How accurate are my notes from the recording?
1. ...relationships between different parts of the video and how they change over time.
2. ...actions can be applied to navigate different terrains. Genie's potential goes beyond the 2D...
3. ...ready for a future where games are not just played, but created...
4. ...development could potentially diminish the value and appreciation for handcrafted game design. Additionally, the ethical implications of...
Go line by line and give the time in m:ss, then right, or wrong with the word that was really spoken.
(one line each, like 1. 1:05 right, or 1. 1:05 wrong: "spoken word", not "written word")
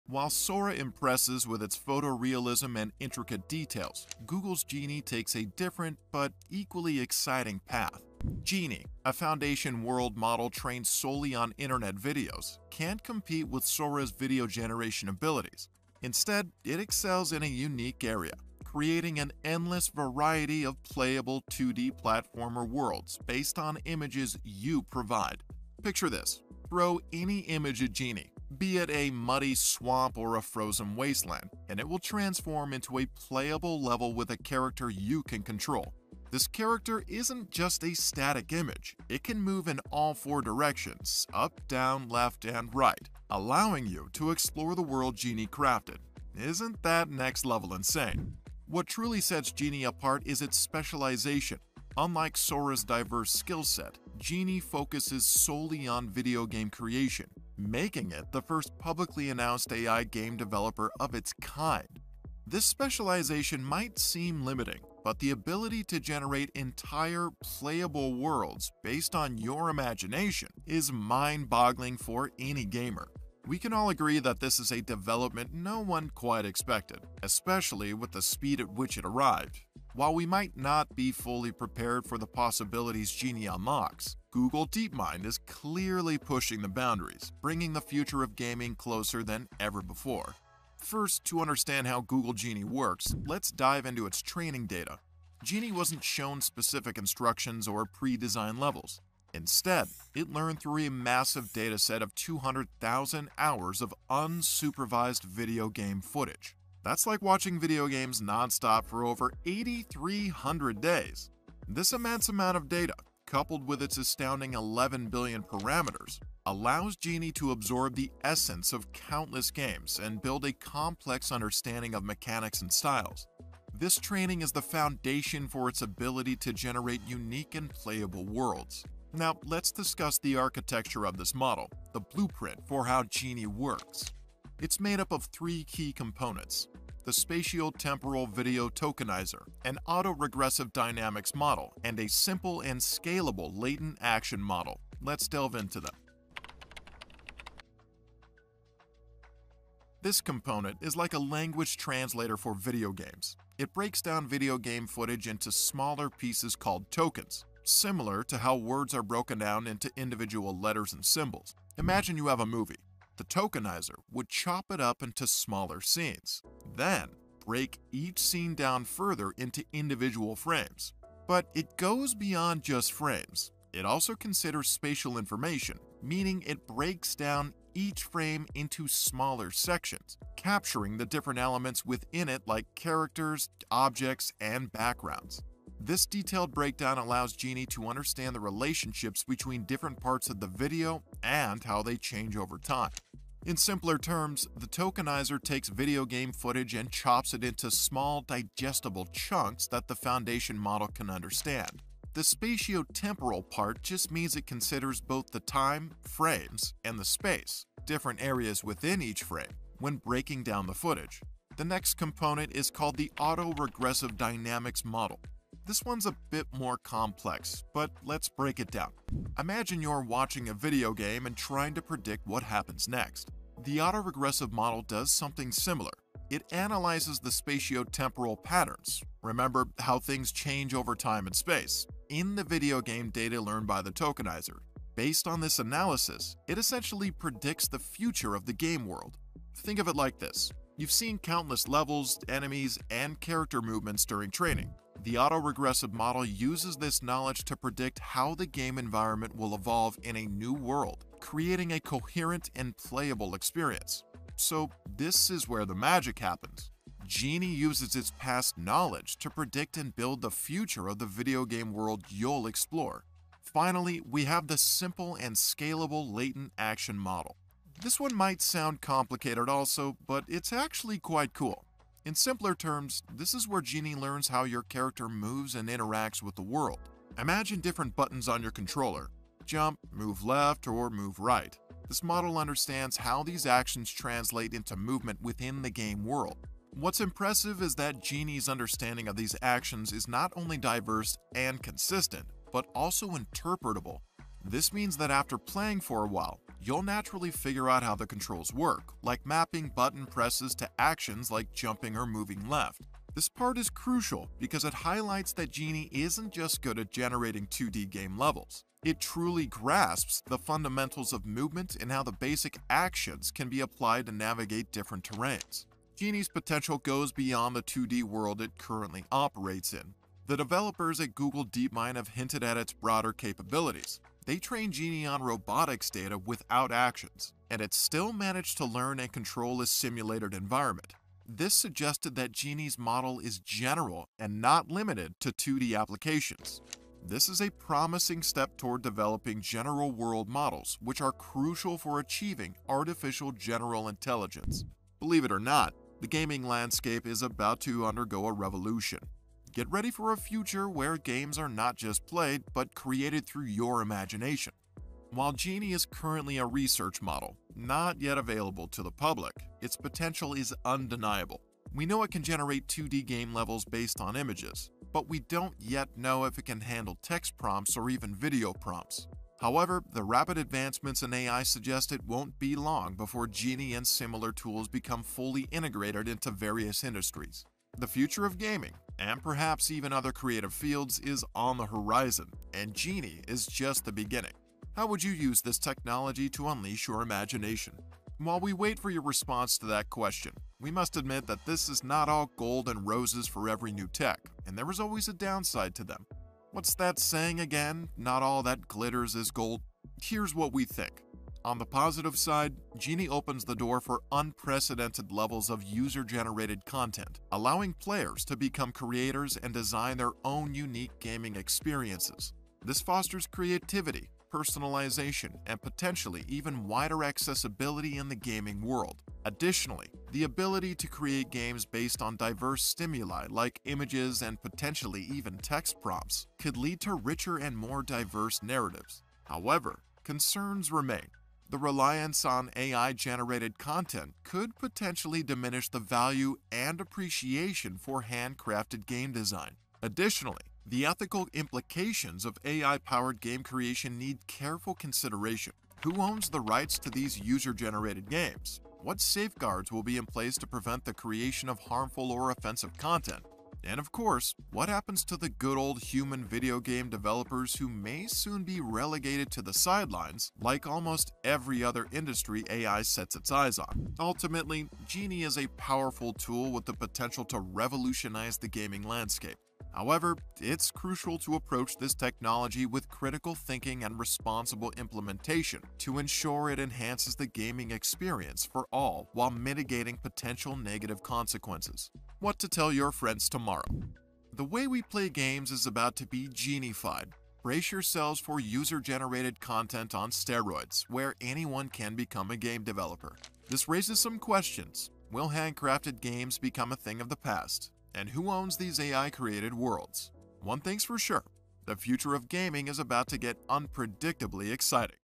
1. 3:08 right
2. 5:12 right
3. 5:49 right
4. 7:13 wrong: "content", not "development".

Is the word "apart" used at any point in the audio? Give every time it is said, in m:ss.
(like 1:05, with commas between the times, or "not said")
0:49.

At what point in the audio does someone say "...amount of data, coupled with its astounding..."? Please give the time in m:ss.
1:52.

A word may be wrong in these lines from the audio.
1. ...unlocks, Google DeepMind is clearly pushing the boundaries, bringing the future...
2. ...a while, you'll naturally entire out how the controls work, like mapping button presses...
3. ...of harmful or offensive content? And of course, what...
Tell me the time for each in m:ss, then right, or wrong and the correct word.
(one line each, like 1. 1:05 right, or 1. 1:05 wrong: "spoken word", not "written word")
1. 1:23 right
2. 4:56 wrong: "figure", not "entire"
3. 7:31 right.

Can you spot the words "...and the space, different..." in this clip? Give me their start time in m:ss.
3:26.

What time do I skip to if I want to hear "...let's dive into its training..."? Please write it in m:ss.
1:33.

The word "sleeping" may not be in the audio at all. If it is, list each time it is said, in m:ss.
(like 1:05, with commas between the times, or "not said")
not said.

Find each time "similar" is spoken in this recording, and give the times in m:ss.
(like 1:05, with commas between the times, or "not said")
2:37, 3:45, 6:13.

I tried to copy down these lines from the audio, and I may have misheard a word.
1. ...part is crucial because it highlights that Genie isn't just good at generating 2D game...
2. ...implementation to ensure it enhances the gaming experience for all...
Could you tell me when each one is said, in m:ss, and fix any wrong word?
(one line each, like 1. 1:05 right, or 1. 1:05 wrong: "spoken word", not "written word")
1. 5:03 right
2. 7:54 right.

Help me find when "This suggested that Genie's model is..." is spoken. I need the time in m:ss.
5:31.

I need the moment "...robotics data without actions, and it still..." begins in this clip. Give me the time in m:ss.
5:25.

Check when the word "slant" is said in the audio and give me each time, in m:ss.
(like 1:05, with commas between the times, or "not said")
not said.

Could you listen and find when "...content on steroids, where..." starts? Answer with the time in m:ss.
8:09.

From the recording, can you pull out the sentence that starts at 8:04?
The way we play games is about to be genified.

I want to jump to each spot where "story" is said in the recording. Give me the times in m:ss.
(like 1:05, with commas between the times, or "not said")
not said.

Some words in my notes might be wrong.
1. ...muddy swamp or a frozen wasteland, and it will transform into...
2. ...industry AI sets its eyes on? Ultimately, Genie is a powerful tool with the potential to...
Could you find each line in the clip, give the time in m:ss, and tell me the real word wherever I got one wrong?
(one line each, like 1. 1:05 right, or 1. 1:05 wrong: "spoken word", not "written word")
1. 0:29 right
2. 7:41 right.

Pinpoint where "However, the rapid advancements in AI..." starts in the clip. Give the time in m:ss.
6:09.